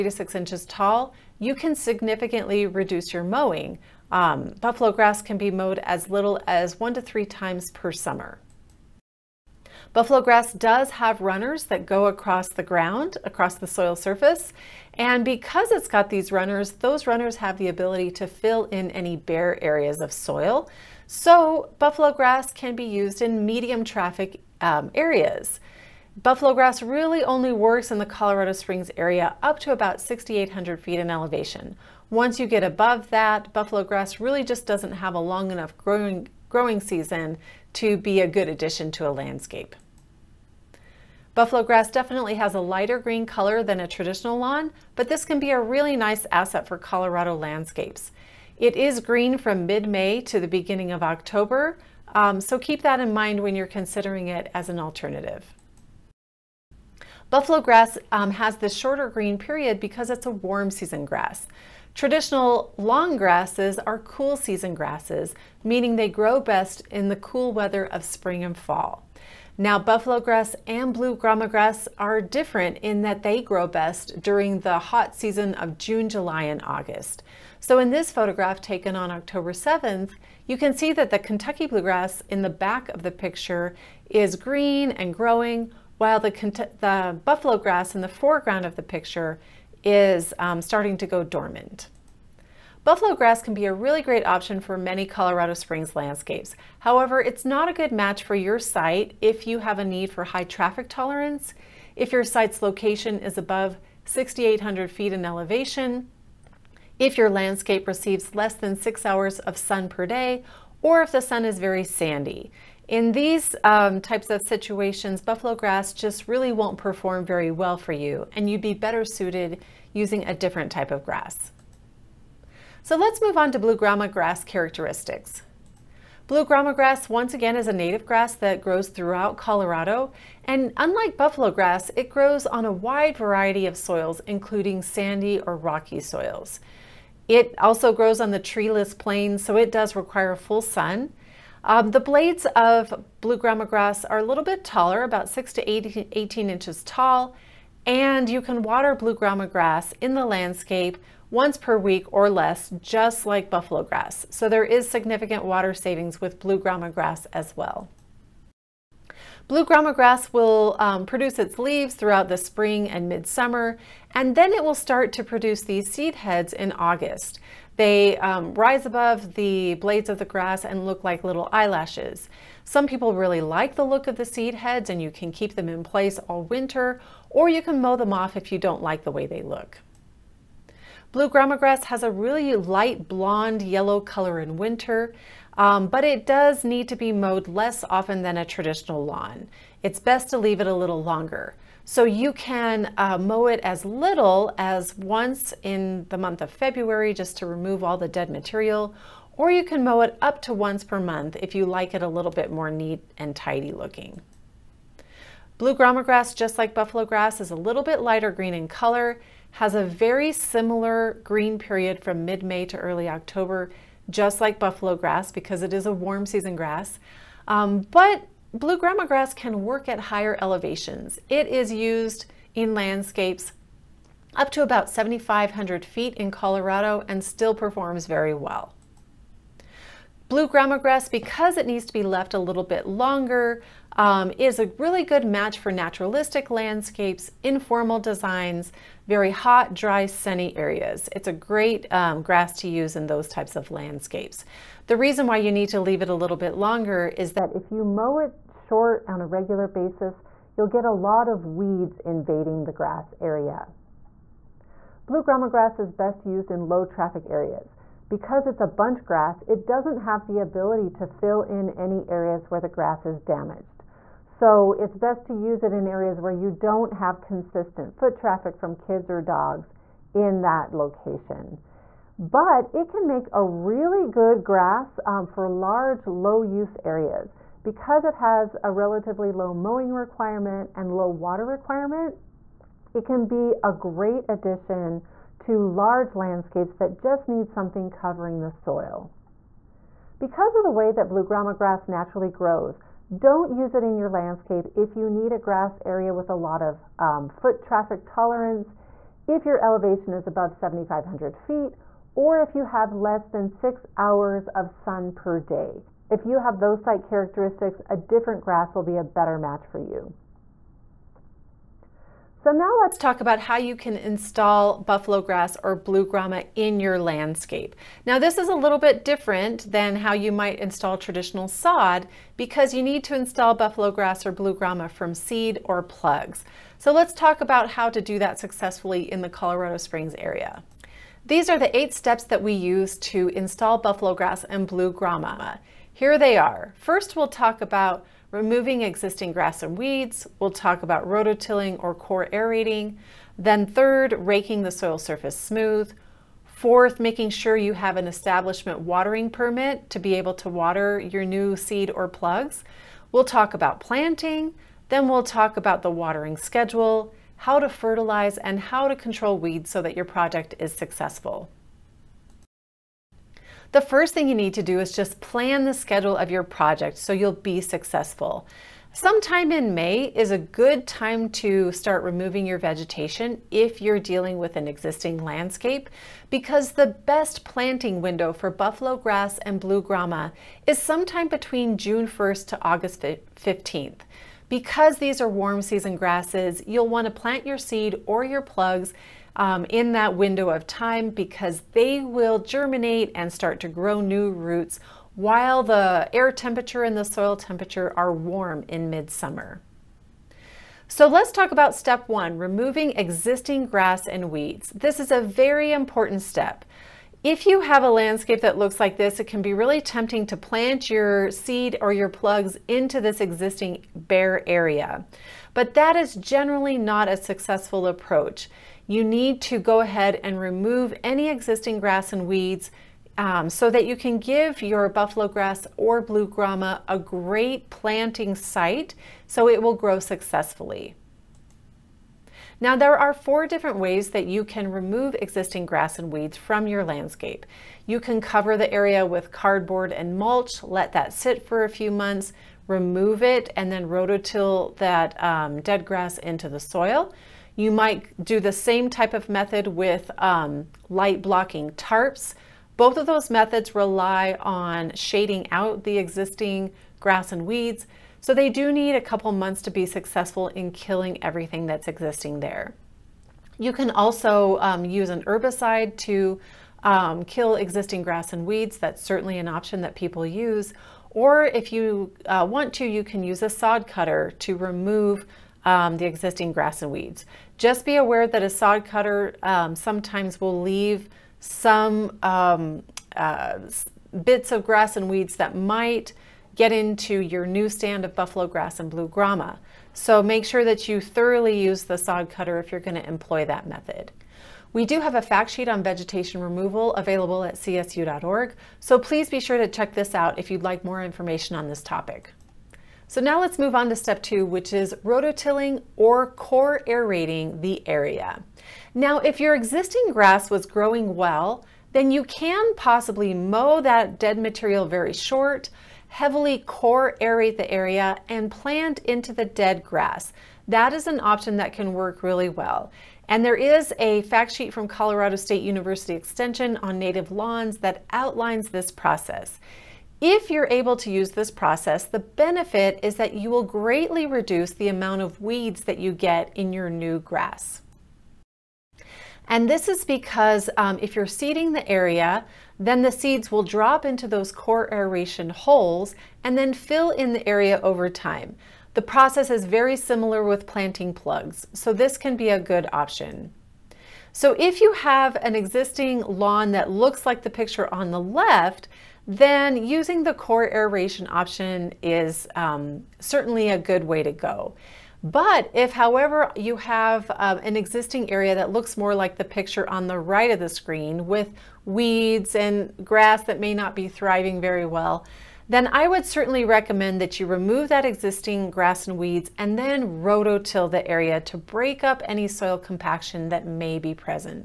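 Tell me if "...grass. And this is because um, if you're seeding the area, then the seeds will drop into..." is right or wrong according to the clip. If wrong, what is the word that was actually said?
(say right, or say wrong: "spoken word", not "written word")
right.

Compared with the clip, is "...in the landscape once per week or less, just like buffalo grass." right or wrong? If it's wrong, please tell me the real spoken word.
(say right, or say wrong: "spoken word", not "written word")
right.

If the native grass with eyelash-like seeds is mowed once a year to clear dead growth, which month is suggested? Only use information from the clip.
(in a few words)
February.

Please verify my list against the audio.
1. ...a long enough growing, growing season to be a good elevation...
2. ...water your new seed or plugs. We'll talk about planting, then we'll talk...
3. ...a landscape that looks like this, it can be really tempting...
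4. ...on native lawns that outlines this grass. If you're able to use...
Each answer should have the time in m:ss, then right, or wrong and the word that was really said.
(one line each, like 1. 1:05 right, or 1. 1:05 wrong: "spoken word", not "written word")
1. 0:35 wrong: "addition", not "elevation"
2. 5:50 right
3. 6:47 right
4. 8:46 wrong: "process", not "grass".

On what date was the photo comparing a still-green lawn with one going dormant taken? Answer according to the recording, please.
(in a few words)
October 7th.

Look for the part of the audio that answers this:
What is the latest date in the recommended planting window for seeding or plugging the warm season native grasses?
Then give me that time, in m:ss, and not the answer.
6:22.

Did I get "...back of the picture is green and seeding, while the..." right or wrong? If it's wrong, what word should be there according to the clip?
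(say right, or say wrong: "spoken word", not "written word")
wrong: "growing", not "seeding".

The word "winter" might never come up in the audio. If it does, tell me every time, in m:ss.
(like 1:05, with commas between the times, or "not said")
2:56, 3:04.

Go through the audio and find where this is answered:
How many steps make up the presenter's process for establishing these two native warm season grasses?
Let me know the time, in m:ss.
5:31.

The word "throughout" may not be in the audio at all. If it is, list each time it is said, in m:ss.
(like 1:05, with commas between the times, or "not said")
2:08, 2:41.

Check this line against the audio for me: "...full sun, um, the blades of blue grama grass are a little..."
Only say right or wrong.
right.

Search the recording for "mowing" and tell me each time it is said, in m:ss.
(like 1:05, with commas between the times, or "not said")
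0:03, 4:39.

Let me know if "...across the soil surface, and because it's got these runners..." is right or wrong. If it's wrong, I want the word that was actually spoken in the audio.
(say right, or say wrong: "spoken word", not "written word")
right.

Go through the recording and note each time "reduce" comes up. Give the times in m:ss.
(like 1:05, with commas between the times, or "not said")
0:02, 8:54.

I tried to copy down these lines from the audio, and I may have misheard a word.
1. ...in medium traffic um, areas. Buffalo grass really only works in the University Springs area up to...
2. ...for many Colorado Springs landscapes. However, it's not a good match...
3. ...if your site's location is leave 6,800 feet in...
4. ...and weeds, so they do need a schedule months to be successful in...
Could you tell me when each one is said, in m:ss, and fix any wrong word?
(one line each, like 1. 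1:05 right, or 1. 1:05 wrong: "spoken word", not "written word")
1. 0:23 wrong: "Colorado", not "University"
2. 1:34 right
3. 1:41 wrong: "above", not "leave"
4. 7:37 wrong: "couple", not "schedule".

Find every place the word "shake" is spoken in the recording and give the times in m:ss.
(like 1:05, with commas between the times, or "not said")
not said.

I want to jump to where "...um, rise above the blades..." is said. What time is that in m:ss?
2:48.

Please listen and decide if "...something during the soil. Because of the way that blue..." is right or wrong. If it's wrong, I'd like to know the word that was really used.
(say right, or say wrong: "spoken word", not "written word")
wrong: "covering", not "during".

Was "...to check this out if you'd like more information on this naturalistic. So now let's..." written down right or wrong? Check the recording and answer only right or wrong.
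wrong.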